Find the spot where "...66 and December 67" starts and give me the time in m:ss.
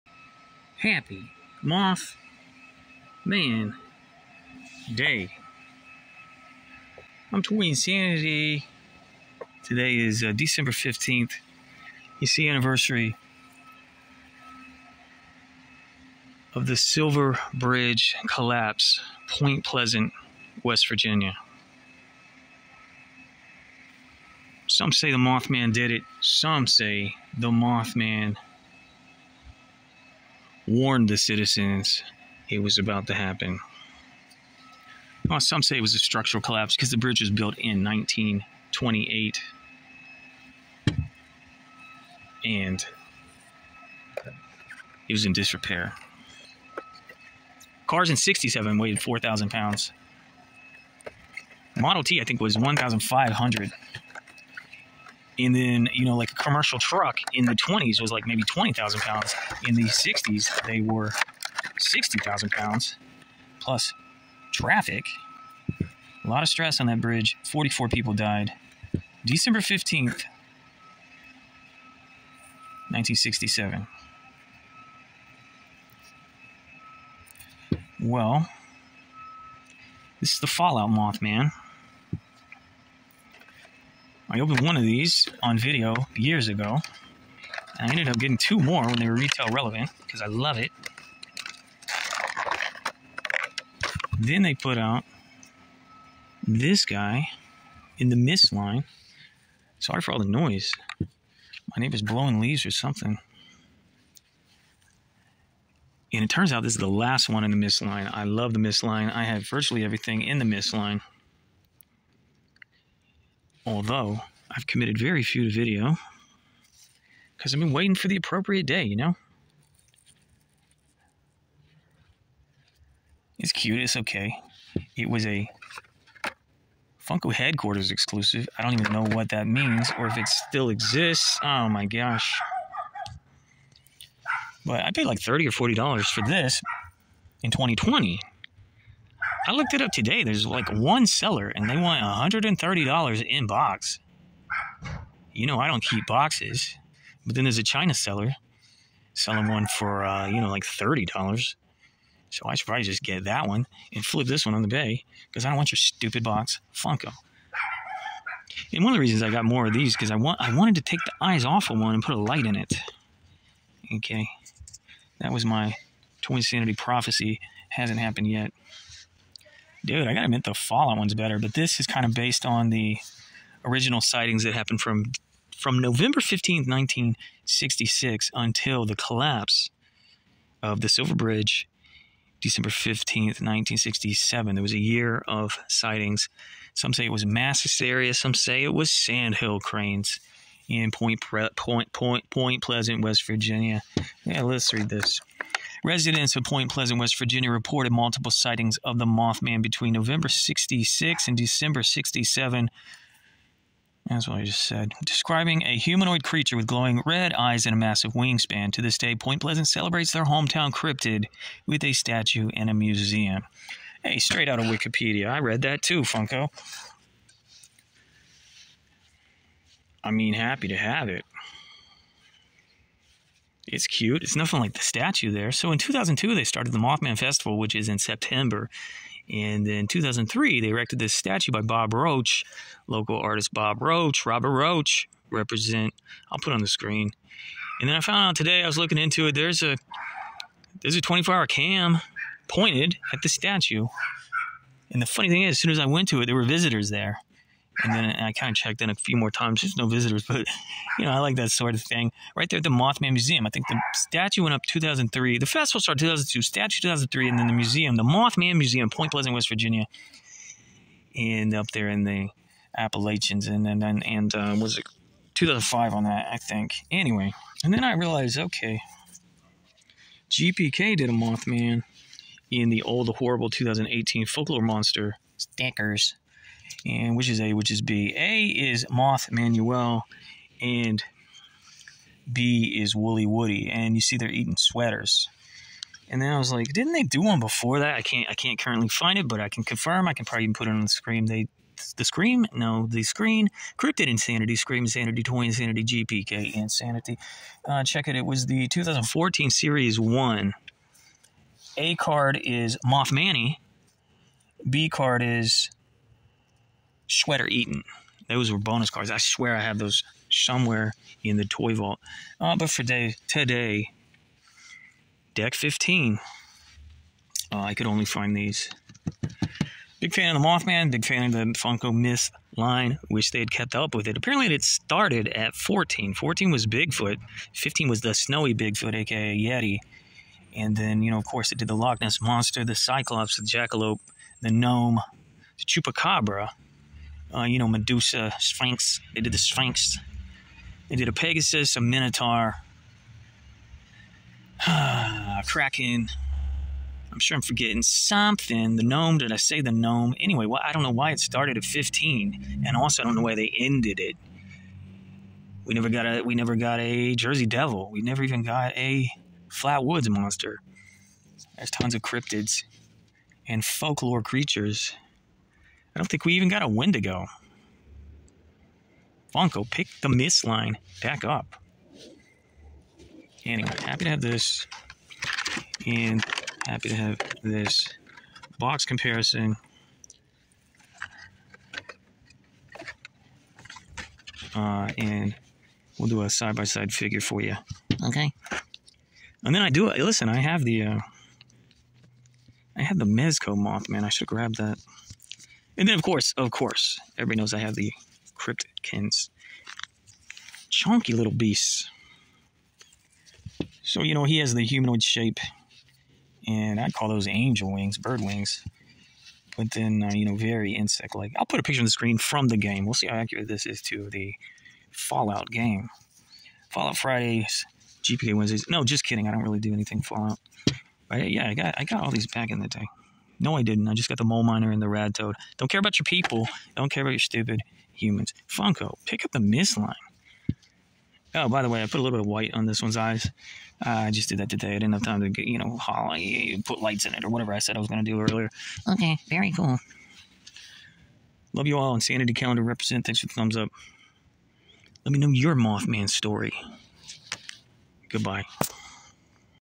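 3:20.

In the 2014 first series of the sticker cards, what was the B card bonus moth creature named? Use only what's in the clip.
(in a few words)
Sweater Eaton.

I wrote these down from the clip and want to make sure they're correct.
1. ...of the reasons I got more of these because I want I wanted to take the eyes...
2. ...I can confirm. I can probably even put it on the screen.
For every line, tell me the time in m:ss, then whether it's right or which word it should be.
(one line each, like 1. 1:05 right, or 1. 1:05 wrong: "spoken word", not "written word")
1. 2:38 right
2. 4:49 right.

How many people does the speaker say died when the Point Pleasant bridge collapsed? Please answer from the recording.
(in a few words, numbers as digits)
44.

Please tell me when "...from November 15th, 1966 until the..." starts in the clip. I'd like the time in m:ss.
2:55.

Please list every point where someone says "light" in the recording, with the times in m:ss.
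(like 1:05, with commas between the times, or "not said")
2:42, 7:16.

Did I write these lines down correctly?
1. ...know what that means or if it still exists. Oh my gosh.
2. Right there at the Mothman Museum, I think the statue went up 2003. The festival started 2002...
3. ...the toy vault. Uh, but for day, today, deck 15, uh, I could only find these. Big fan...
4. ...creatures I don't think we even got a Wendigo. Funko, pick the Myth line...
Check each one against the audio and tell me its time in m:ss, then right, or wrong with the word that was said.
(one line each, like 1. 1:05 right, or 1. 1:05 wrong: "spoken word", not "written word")
1. 2:08 right
2. 4:12 right
3. 5:11 right
4. 6:04 right.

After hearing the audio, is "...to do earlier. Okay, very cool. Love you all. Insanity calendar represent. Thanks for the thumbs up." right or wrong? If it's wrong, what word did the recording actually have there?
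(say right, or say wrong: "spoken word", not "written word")
right.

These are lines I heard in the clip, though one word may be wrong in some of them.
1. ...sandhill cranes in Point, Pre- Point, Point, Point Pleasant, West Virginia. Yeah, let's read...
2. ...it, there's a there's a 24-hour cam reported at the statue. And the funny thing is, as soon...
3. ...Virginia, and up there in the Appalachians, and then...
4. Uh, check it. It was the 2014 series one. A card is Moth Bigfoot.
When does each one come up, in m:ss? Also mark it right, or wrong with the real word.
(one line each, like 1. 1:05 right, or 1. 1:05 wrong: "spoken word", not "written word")
1. 3:08 right
2. 3:59 wrong: "pointed", not "reported"
3. 4:19 right
4. 4:57 wrong: "Manny", not "Bigfoot".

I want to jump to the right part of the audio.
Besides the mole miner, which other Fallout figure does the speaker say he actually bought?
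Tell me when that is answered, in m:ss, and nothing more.
7:04.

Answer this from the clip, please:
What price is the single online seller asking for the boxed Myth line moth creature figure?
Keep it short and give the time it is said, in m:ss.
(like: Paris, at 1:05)
$130, at 2:22.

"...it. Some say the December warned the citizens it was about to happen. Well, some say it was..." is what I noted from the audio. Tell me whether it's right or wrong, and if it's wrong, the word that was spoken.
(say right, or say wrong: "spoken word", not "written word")
wrong: "Mothman", not "December".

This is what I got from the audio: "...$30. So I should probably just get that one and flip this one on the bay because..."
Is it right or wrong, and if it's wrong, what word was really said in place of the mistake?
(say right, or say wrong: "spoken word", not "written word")
right.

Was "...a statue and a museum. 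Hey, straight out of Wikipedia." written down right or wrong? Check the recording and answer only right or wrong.
right.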